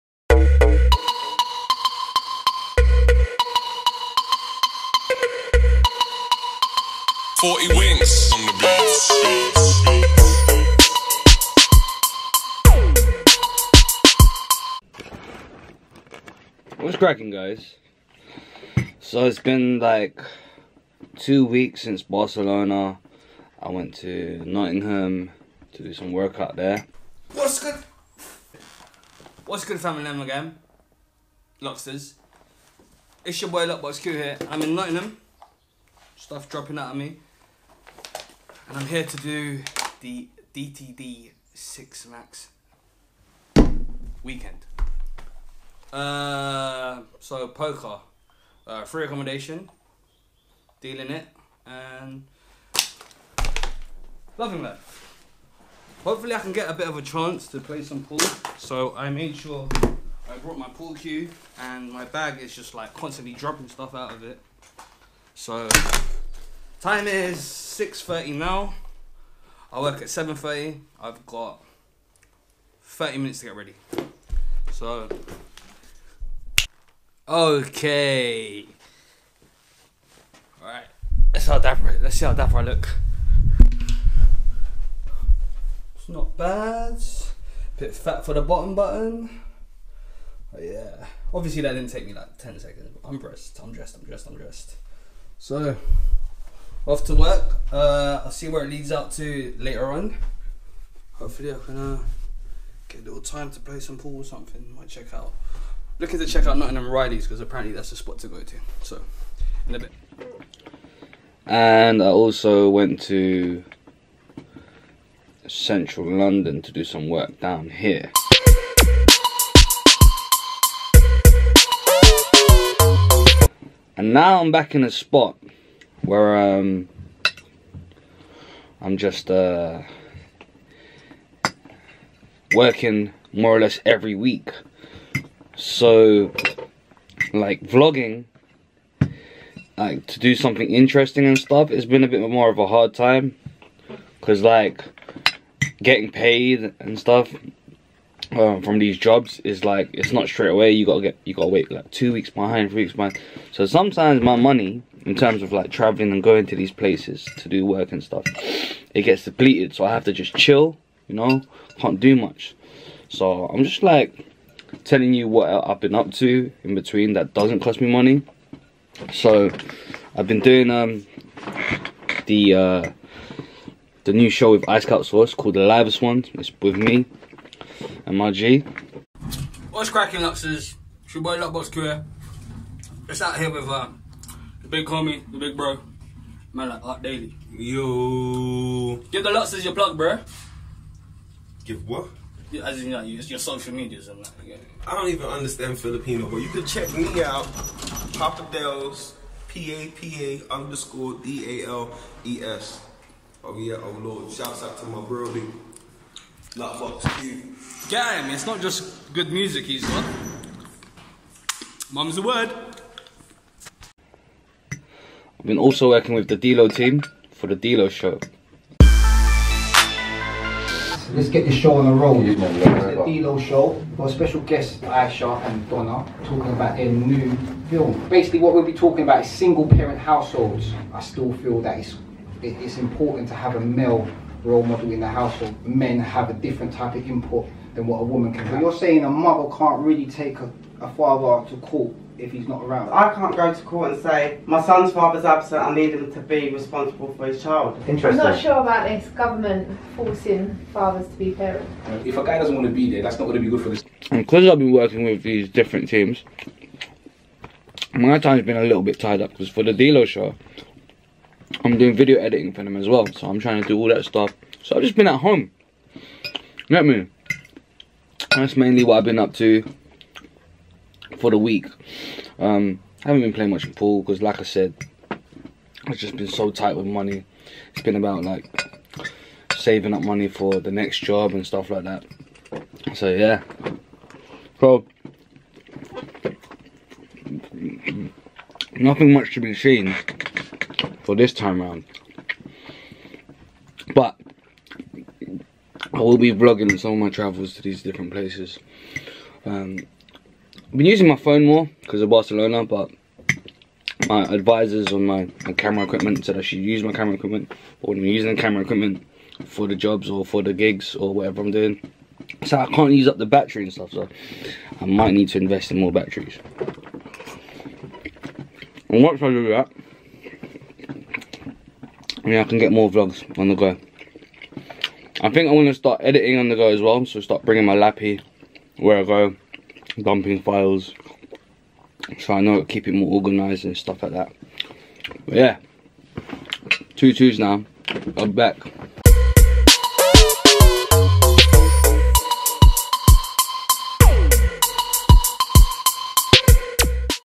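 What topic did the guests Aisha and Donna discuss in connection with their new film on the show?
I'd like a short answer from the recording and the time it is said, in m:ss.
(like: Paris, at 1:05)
single parent households, at 3:49.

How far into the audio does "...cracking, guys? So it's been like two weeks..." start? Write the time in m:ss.
0:16.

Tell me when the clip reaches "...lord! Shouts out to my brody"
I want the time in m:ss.
3:24.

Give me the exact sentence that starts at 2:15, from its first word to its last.
So, like vlogging, like to do something interesting and stuff, it's been a bit more of a hard time.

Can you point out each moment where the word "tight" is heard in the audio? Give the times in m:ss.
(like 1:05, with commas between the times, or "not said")
4:36.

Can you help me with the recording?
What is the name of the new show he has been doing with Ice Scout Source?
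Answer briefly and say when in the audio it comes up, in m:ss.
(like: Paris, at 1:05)
The Live Ones, at 2:55.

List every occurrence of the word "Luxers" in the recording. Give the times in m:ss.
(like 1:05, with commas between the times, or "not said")
3:00, 3:09.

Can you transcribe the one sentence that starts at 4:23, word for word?
So I'm trying to do all that stuff.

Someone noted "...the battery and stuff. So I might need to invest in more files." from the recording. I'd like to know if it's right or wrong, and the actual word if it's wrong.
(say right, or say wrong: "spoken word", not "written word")
wrong: "batteries", not "files".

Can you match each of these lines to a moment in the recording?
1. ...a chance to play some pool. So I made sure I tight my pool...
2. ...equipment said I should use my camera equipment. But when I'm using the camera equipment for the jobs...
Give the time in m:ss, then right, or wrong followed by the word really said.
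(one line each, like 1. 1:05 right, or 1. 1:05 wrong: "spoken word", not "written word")
1. 0:56 wrong: "brought", not "tight"
2. 5:05 right.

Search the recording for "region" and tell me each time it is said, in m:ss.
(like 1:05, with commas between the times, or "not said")
not said.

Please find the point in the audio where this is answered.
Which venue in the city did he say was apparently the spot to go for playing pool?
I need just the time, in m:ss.
1:46.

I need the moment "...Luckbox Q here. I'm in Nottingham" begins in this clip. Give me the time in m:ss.
0:33.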